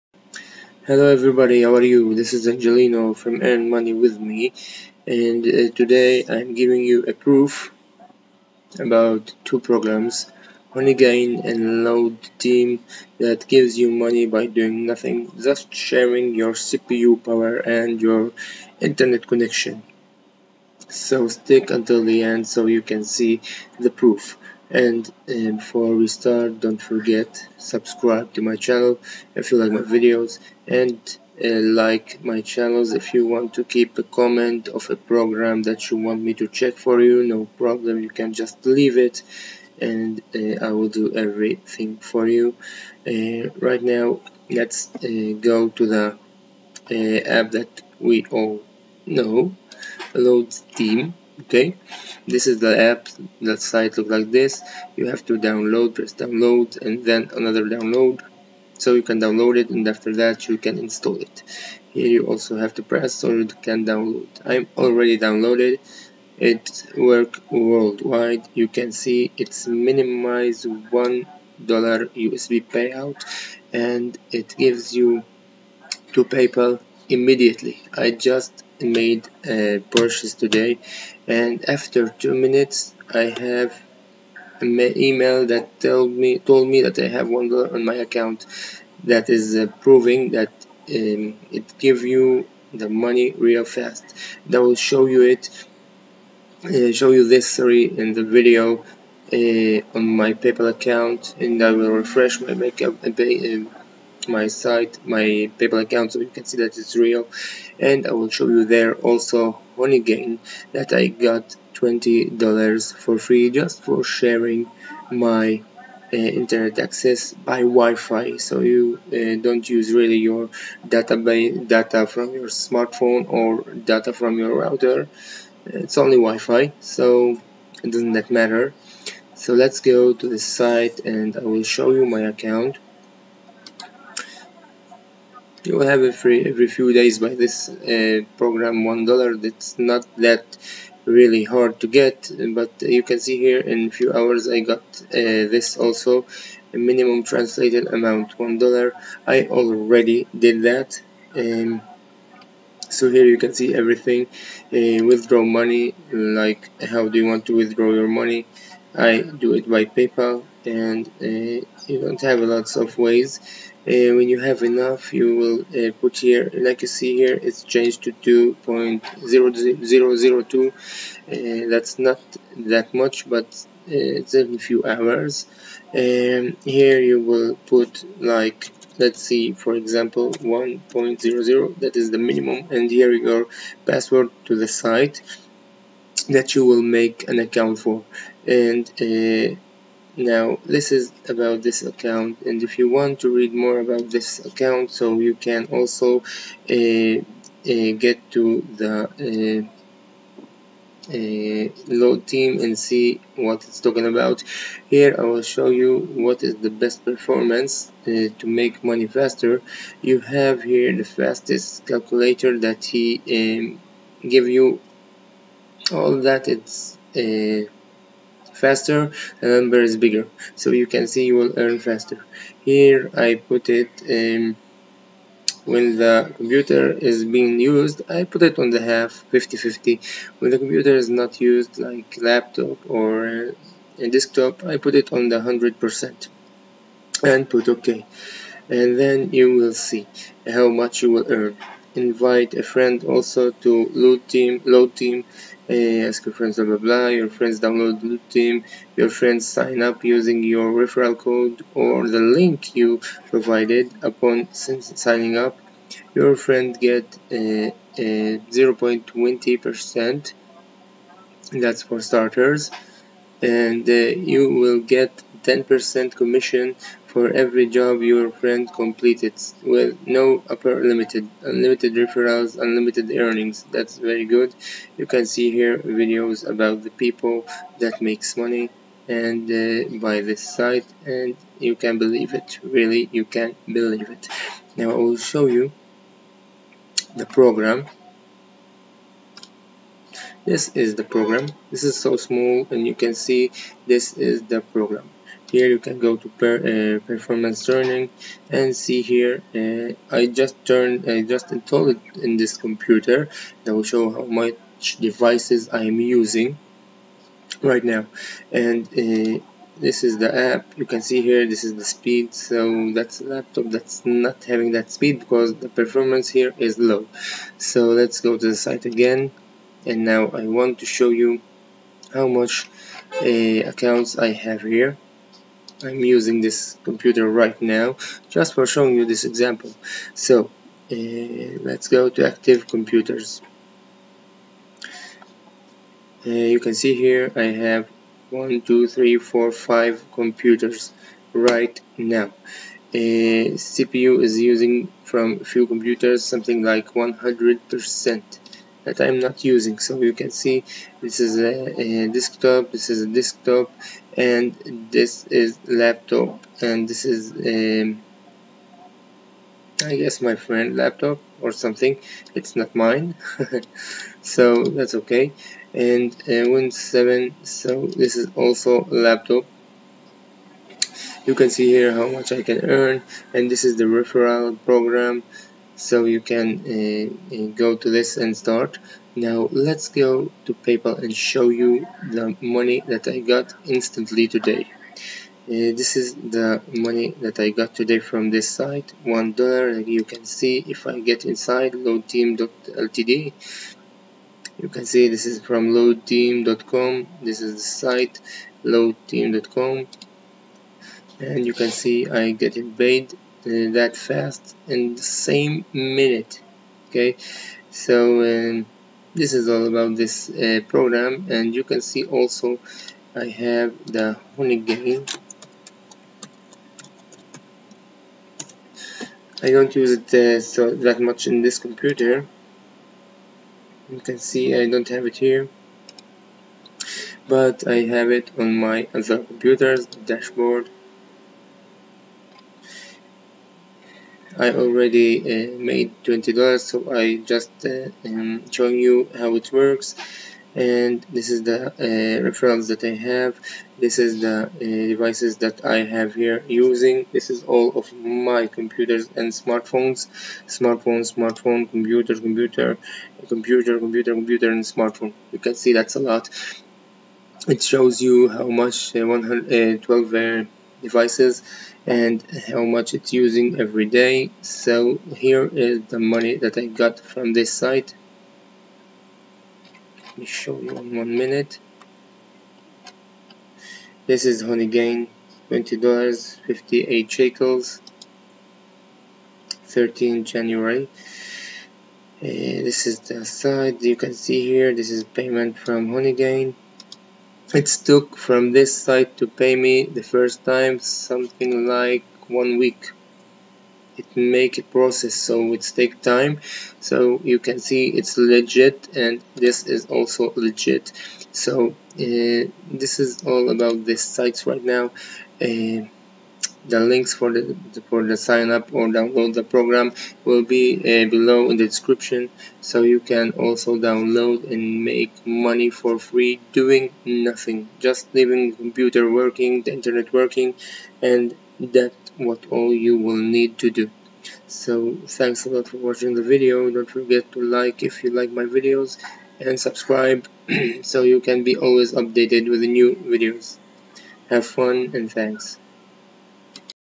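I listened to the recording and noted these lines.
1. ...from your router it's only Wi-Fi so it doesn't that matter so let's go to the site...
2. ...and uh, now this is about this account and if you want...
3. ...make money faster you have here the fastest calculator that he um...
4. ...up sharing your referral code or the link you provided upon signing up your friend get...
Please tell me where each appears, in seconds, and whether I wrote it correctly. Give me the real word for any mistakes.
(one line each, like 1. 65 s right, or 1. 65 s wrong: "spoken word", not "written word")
1. 124 s right
2. 188 s right
3. 208 s right
4. 249 s wrong: "using", not "sharing".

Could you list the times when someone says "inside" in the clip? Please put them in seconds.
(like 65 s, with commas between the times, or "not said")
391 s.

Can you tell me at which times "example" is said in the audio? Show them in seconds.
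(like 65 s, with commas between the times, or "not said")
179 s, 329 s.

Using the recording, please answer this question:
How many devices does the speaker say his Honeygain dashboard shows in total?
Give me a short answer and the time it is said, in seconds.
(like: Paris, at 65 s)
112, at 459 s.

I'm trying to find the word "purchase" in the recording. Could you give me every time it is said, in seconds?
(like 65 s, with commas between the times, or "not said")
79 s.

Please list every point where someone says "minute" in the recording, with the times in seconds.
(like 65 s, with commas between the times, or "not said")
82 s, 405 s, 471 s.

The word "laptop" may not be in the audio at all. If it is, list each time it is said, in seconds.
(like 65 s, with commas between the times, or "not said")
232 s, 313 s, 355 s, 360 s, 369 s.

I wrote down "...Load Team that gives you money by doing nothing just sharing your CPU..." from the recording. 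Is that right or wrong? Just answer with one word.
right.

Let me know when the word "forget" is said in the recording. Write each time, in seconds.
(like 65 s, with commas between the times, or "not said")
26 s, 526 s.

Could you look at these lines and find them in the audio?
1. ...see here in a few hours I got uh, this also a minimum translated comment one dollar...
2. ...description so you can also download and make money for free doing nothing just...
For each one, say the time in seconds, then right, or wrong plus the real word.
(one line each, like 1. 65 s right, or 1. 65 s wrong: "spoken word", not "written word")
1. 143 s wrong: "amount", not "comment"
2. 511 s right.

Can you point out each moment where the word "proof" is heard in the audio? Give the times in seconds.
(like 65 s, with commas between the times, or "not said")
7 s, 23 s.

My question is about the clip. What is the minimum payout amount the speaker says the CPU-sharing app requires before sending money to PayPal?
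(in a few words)
$1.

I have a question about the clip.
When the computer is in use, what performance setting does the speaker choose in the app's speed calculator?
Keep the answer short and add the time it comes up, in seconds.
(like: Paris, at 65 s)
50-50, at 229 s.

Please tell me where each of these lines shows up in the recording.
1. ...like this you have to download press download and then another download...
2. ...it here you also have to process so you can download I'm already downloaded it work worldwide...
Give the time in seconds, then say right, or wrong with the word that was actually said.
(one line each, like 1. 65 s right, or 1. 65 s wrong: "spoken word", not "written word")
1. 54 s right
2. 61 s wrong: "press", not "process".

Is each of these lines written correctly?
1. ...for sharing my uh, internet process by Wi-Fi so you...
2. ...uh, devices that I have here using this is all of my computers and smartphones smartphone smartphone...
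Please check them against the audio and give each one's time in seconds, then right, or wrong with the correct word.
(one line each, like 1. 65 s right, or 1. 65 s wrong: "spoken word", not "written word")
1. 113 s wrong: "access", not "process"
2. 444 s right.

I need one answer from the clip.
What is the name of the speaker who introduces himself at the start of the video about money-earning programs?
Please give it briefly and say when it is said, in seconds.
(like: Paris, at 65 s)
Angelino, at 2 s.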